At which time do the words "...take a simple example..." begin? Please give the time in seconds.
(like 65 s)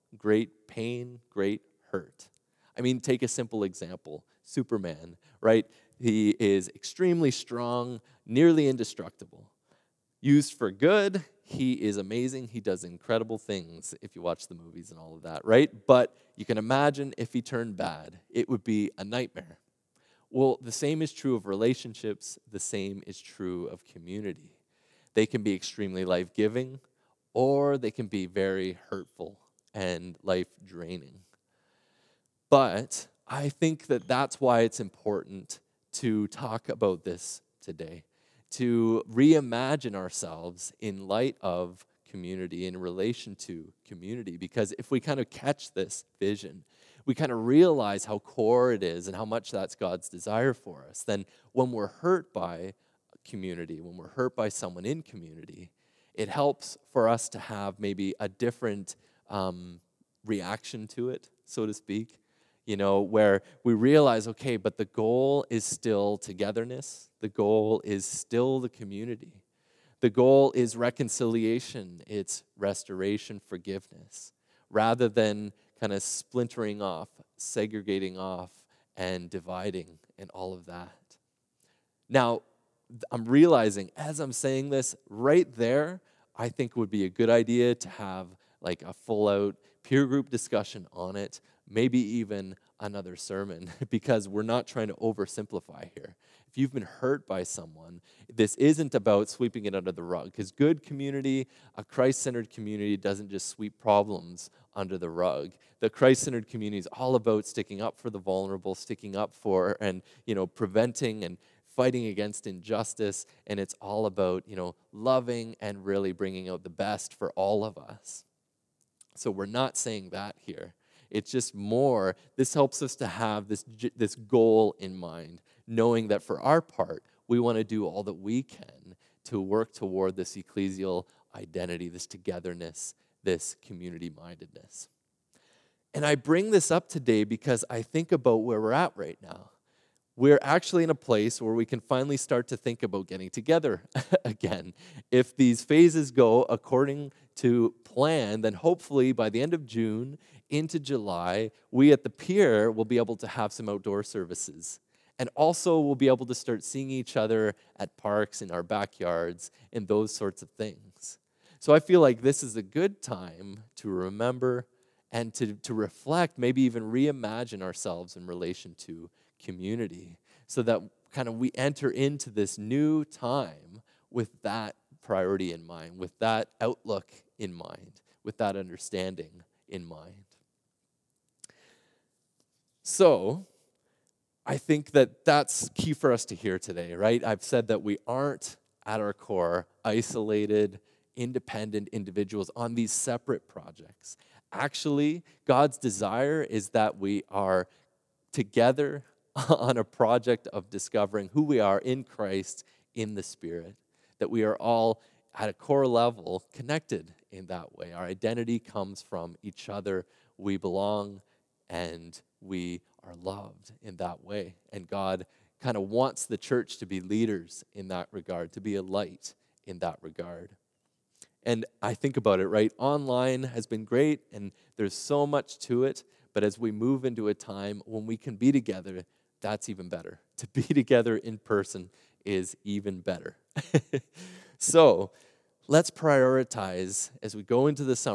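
3 s.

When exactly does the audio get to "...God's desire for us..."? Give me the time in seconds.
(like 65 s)
49 s.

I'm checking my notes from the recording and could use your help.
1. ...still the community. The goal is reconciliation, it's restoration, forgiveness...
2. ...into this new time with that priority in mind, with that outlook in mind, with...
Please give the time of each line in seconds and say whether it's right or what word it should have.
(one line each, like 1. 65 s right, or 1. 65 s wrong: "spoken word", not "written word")
1. 68 s right
2. 171 s right.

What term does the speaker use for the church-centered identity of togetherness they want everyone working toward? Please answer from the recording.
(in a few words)
ecclesial identity.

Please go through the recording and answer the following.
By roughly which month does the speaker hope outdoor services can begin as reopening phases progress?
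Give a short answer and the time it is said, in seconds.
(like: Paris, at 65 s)
July, at 150 s.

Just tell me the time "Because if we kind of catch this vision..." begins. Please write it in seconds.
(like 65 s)
44 s.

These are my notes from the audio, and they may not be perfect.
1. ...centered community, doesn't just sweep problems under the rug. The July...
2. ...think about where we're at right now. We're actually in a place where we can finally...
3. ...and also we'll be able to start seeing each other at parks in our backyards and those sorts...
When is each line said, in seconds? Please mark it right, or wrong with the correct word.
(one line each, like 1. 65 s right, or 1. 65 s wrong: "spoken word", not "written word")
1. 102 s wrong: "Christ", not "July"
2. 137 s right
3. 155 s right.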